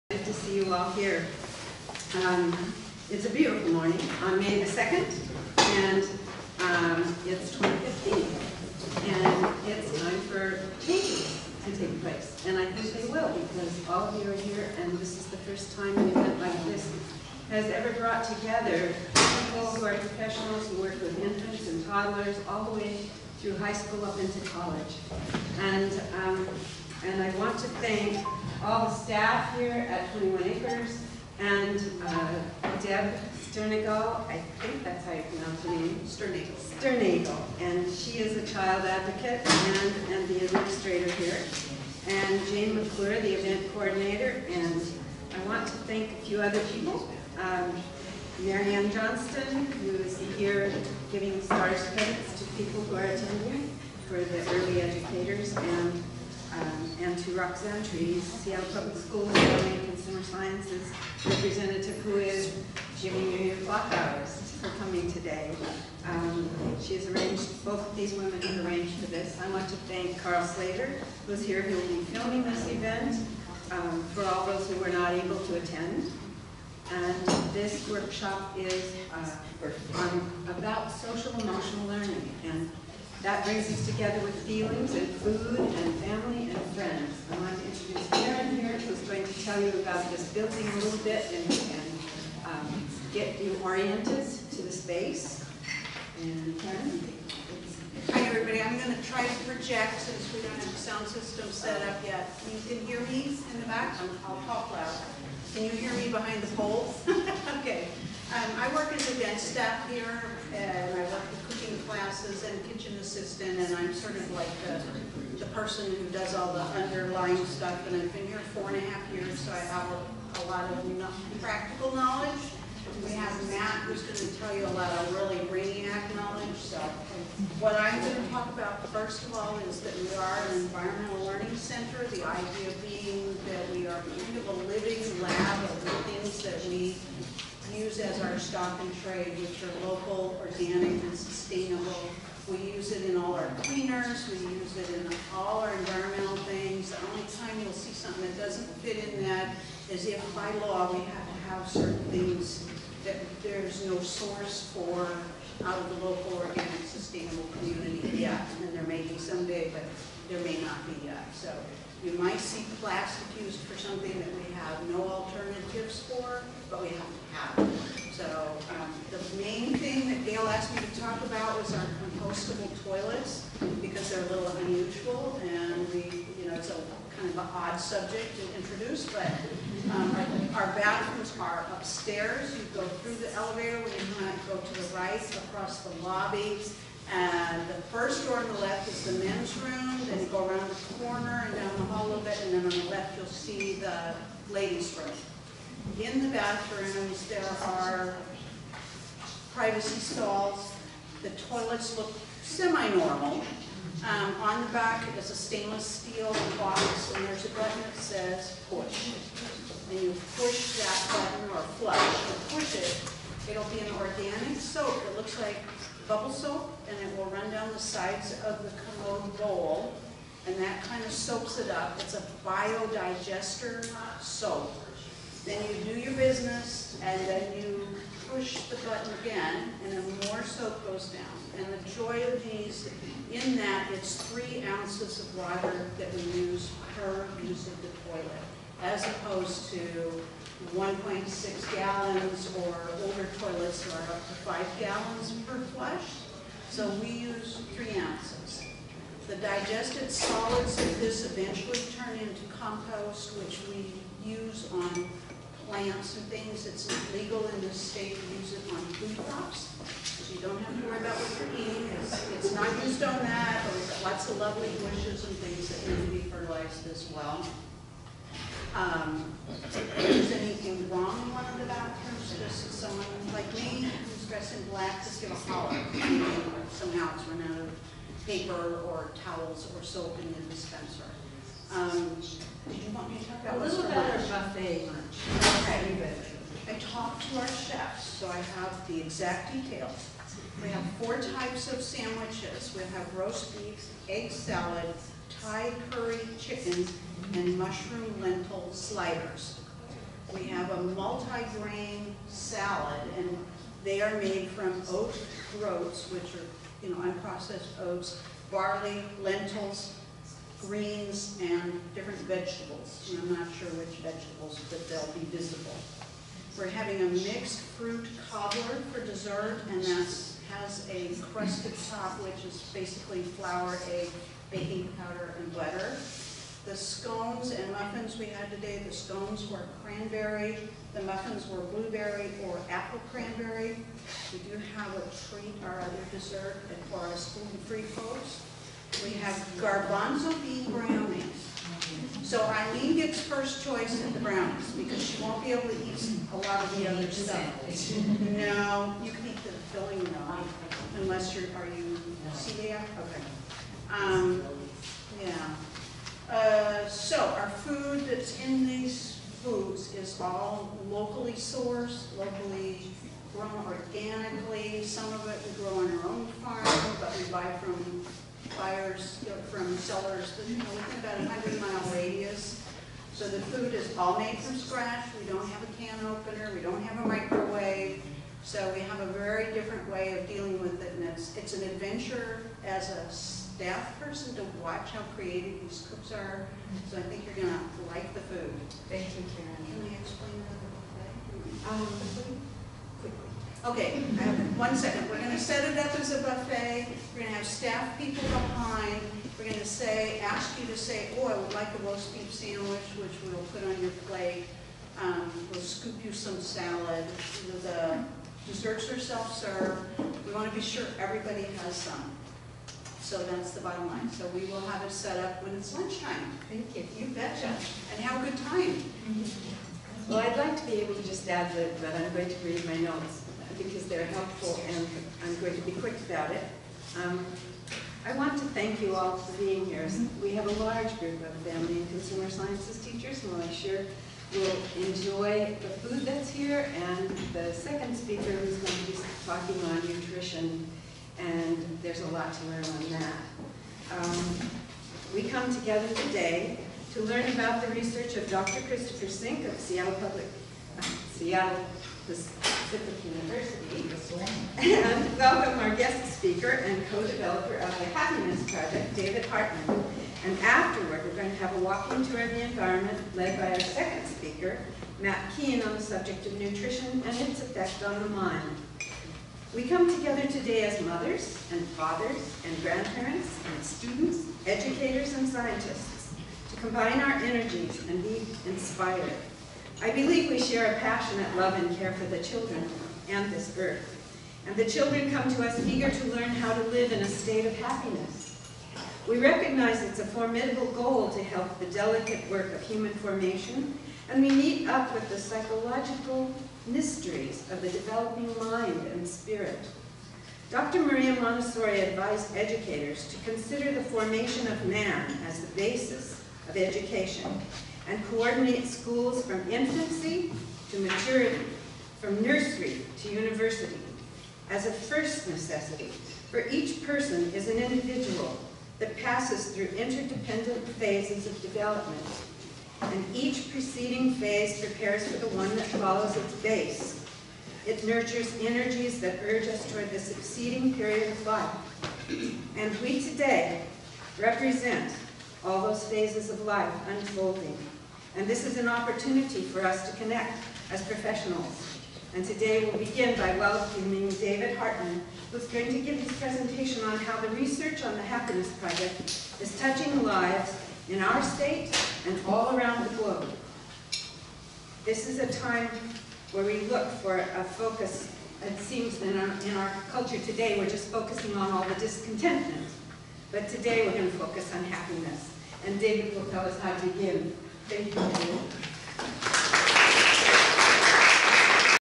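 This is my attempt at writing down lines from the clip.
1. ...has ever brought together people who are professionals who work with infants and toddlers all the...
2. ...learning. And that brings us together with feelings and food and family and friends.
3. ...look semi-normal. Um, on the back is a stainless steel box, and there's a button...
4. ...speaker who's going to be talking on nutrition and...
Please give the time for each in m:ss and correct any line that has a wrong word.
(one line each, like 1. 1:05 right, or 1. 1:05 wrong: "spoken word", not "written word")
1. 0:17 right
2. 1:21 right
3. 3:21 right
4. 7:17 right.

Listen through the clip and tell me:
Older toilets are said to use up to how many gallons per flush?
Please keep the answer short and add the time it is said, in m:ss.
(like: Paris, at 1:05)
5 gallons, at 4:04.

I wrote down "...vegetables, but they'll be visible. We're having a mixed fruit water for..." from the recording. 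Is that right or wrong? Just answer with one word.
wrong.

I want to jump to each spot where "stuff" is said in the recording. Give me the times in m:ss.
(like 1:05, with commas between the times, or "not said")
1:57, 5:47.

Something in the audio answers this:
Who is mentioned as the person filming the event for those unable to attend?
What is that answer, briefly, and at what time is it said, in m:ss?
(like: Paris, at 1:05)
Carl Slater, at 1:10.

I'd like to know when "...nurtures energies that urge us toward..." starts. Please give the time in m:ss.
8:47.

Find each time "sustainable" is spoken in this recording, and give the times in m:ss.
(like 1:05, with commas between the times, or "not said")
2:21, 2:36.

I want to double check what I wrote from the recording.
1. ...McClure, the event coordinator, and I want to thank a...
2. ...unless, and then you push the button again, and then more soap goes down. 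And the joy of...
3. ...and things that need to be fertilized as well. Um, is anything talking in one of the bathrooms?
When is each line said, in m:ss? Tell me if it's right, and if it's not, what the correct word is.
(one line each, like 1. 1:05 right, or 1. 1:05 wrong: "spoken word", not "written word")
1. 0:42 right
2. 3:46 wrong: "business", not "unless"
3. 4:25 wrong: "wrong", not "talking".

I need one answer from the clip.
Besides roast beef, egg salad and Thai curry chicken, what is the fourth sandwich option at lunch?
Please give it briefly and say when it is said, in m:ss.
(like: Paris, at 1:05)
Mushroom lentil sliders, at 4:57.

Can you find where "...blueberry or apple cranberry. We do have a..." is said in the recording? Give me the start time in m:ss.
5:31.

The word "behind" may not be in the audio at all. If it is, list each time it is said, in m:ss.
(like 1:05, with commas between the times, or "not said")
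1:46, 6:38.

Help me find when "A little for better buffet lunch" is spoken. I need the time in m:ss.
4:43.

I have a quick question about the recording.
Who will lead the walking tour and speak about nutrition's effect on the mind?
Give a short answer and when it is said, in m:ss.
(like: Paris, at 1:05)
Matt Keane, at 7:44.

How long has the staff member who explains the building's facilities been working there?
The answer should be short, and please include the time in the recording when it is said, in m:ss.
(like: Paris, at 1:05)
Four and a half years, at 1:58.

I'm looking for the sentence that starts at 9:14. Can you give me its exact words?
This is a time where we look for a focus.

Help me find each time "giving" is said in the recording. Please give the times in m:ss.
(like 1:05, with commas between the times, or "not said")
0:51.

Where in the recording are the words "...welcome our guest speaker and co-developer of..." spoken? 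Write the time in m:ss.
7:35.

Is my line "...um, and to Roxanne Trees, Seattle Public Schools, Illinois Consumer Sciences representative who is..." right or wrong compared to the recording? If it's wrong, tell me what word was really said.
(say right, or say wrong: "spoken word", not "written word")
right.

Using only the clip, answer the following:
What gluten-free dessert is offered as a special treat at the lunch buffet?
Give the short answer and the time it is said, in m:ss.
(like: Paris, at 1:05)
Garbanzo bean brownies, at 5:39.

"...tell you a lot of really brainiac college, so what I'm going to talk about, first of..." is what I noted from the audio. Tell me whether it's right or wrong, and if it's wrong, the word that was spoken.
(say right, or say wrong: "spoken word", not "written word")
wrong: "knowledge", not "college".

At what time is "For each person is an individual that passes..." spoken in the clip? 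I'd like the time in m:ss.
8:36.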